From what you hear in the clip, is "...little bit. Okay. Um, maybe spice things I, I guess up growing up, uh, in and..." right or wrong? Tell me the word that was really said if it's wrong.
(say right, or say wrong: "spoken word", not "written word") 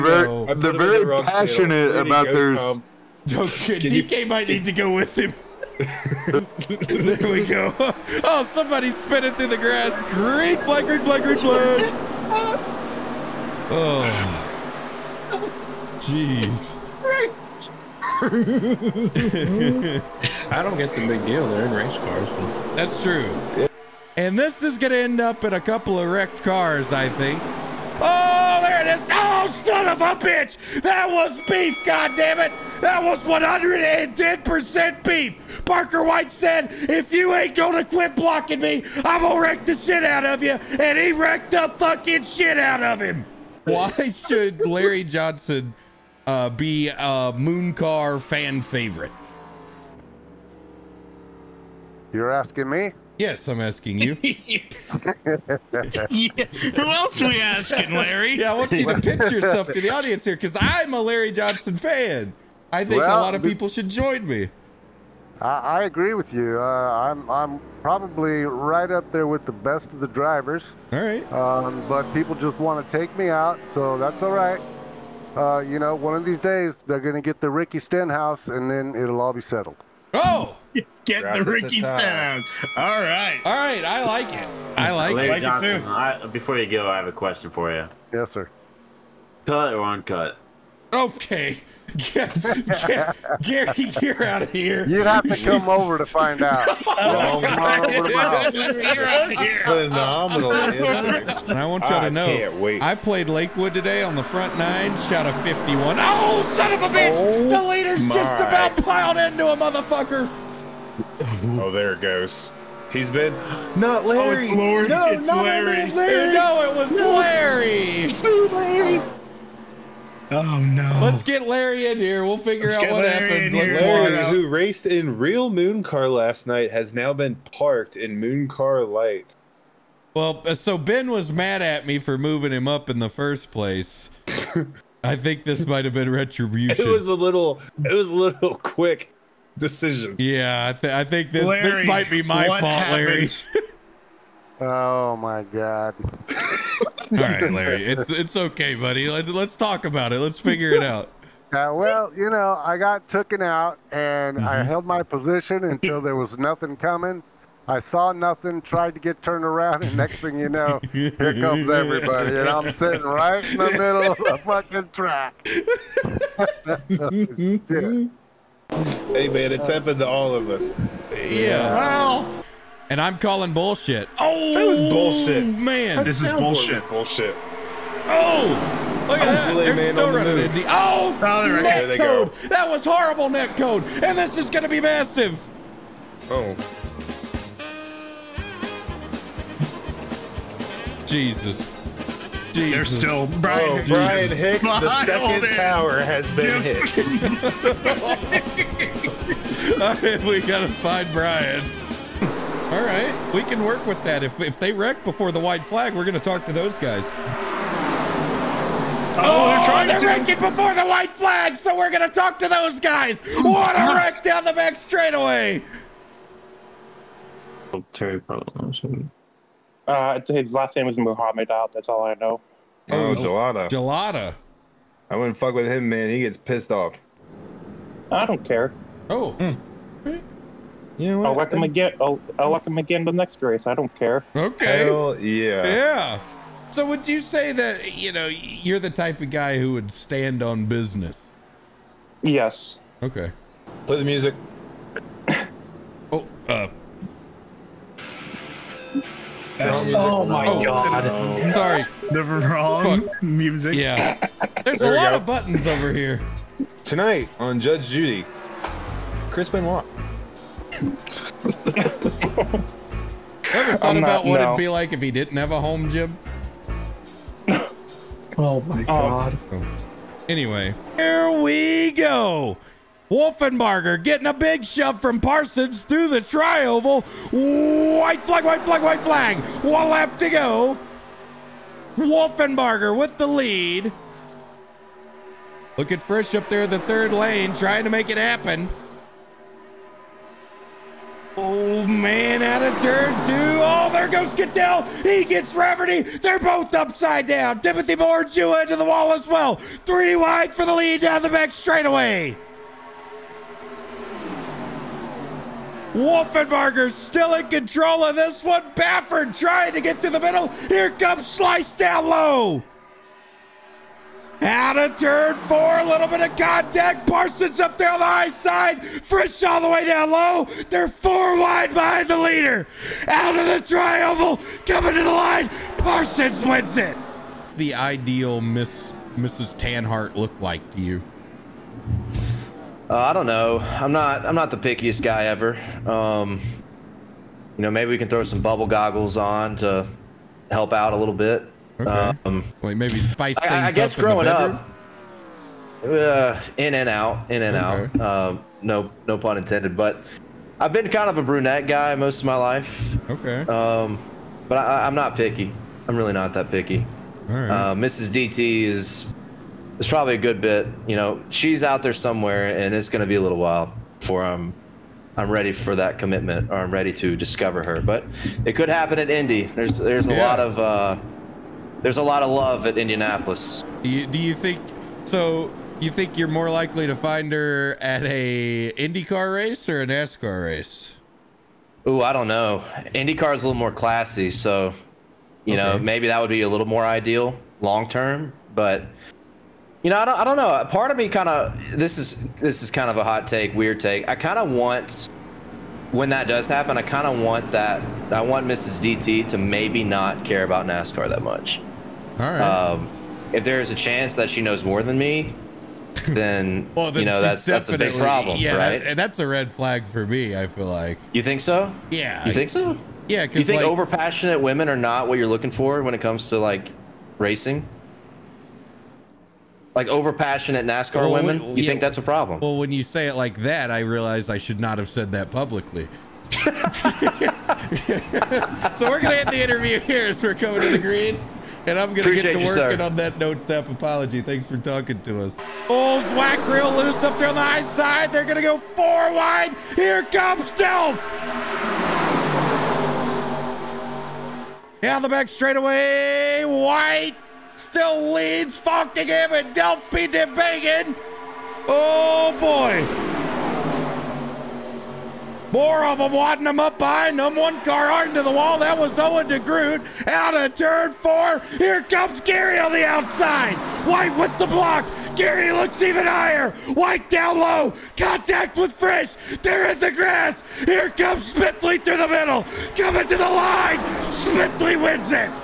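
right.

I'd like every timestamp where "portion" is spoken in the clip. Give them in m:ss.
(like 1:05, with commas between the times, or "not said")
not said.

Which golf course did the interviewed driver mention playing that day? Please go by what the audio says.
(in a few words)
Lakewood.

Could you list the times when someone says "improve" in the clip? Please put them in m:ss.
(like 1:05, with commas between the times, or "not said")
not said.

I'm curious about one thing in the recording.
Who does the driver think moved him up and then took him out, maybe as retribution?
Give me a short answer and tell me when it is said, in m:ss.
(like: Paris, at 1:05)
Ben, at 2:10.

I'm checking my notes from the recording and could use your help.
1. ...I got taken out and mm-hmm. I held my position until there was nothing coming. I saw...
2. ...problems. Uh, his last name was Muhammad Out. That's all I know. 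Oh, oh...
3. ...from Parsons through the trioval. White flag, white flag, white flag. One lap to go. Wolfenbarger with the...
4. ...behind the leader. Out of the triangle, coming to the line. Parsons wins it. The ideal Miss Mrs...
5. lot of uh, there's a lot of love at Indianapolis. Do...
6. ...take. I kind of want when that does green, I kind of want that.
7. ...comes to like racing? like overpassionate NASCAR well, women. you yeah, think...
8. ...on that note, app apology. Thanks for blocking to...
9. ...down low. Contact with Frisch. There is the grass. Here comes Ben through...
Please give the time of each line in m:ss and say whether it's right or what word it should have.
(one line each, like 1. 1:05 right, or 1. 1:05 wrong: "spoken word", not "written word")
1. 2:32 right
2. 3:38 right
3. 4:34 right
4. 5:21 right
5. 6:10 right
6. 6:33 wrong: "happen", not "green"
7. 6:55 right
8. 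7:12 wrong: "talking", not "blocking"
9. 7:47 wrong: "Smithley", not "Ben".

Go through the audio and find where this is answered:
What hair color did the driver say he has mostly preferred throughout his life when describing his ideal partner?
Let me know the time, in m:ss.
5:51.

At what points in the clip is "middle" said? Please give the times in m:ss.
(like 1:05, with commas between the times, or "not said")
2:43, 5:10, 7:52.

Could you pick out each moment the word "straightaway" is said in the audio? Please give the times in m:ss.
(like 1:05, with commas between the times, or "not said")
3:34, 5:01, 7:25.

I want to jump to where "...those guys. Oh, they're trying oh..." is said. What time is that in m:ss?
3:26.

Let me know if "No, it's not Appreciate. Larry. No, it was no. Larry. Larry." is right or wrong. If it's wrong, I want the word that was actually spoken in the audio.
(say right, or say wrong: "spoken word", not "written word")
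wrong: "Larry", not "Appreciate".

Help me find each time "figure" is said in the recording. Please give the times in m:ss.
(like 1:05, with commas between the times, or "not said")
2:02, 2:30.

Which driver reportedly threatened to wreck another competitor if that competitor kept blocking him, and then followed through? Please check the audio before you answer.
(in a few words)
Parker White.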